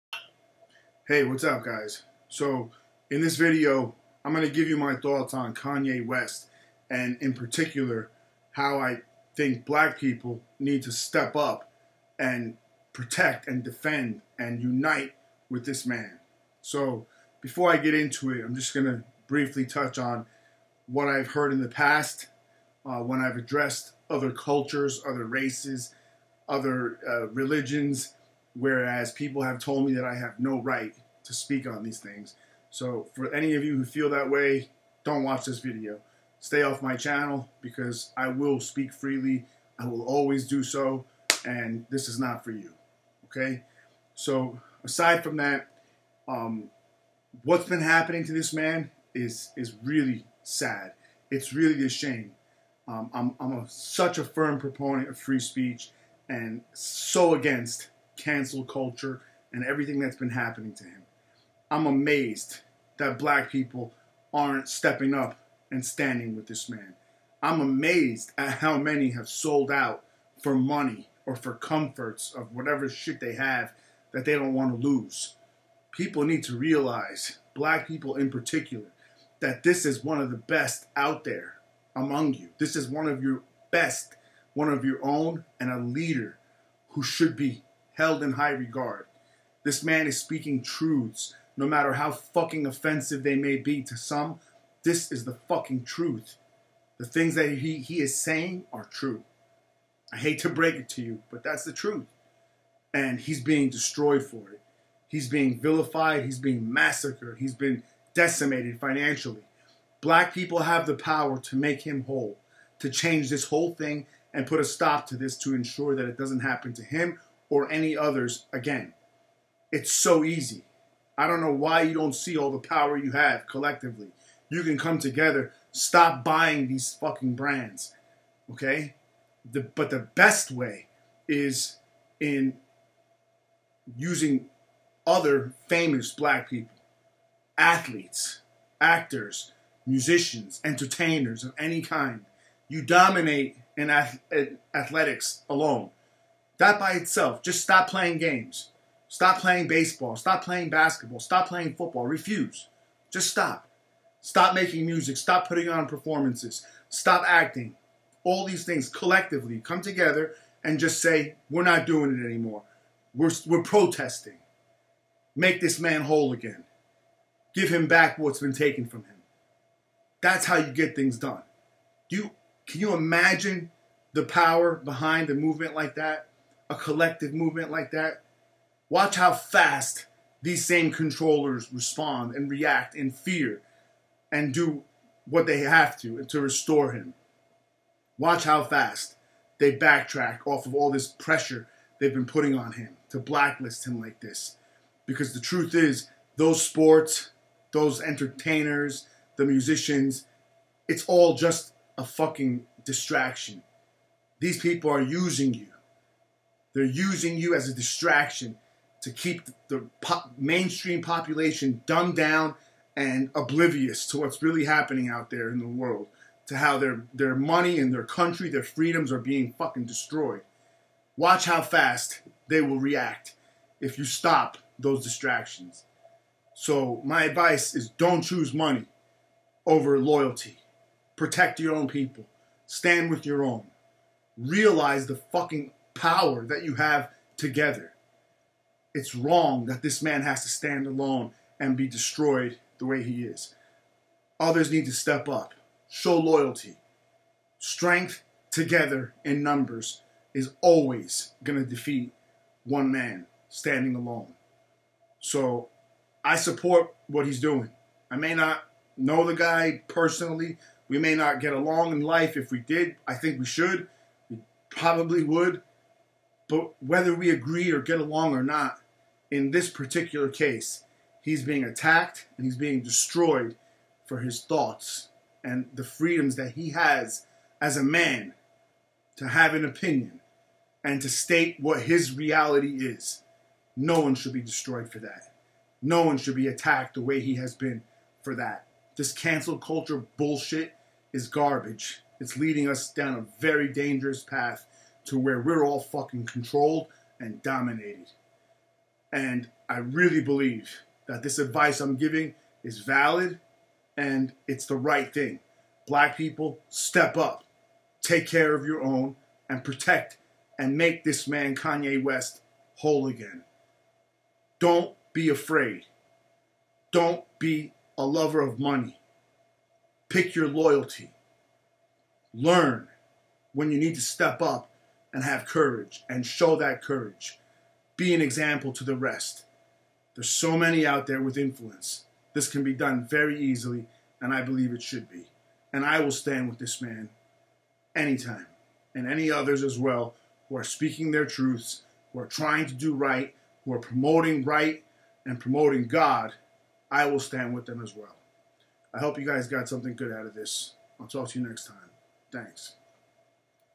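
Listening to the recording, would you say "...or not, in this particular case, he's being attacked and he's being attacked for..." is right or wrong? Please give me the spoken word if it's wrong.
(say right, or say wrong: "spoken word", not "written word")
wrong: "destroyed", not "attacked".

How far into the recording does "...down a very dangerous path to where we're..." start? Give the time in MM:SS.
04:52.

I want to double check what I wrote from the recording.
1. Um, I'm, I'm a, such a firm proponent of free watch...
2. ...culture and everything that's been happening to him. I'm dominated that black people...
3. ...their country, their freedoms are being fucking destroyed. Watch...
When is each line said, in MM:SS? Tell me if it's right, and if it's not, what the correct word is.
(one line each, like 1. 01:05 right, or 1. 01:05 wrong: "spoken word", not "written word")
1. 00:52 wrong: "speech", not "watch"
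2. 00:58 wrong: "amazed", not "dominated"
3. 03:37 right.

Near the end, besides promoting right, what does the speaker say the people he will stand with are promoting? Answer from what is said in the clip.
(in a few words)
God.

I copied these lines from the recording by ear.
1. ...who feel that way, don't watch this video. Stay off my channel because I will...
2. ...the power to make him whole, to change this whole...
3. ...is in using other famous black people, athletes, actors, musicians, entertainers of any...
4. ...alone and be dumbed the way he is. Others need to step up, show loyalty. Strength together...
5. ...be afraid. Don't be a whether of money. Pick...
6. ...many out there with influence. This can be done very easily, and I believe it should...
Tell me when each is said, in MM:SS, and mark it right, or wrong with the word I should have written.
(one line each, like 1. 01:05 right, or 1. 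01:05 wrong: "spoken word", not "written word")
1. 00:33 right
2. 01:50 right
3. 02:11 right
4. 04:00 wrong: "destroyed", not "dumbed"
5. 05:15 wrong: "lover", not "whether"
6. 05:30 right.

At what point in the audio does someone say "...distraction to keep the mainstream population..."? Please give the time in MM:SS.
03:27.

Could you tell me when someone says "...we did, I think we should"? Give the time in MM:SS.
04:22.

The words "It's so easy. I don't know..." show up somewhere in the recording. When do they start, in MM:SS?
01:59.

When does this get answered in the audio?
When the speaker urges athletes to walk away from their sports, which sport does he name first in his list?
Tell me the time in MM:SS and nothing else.
02:29.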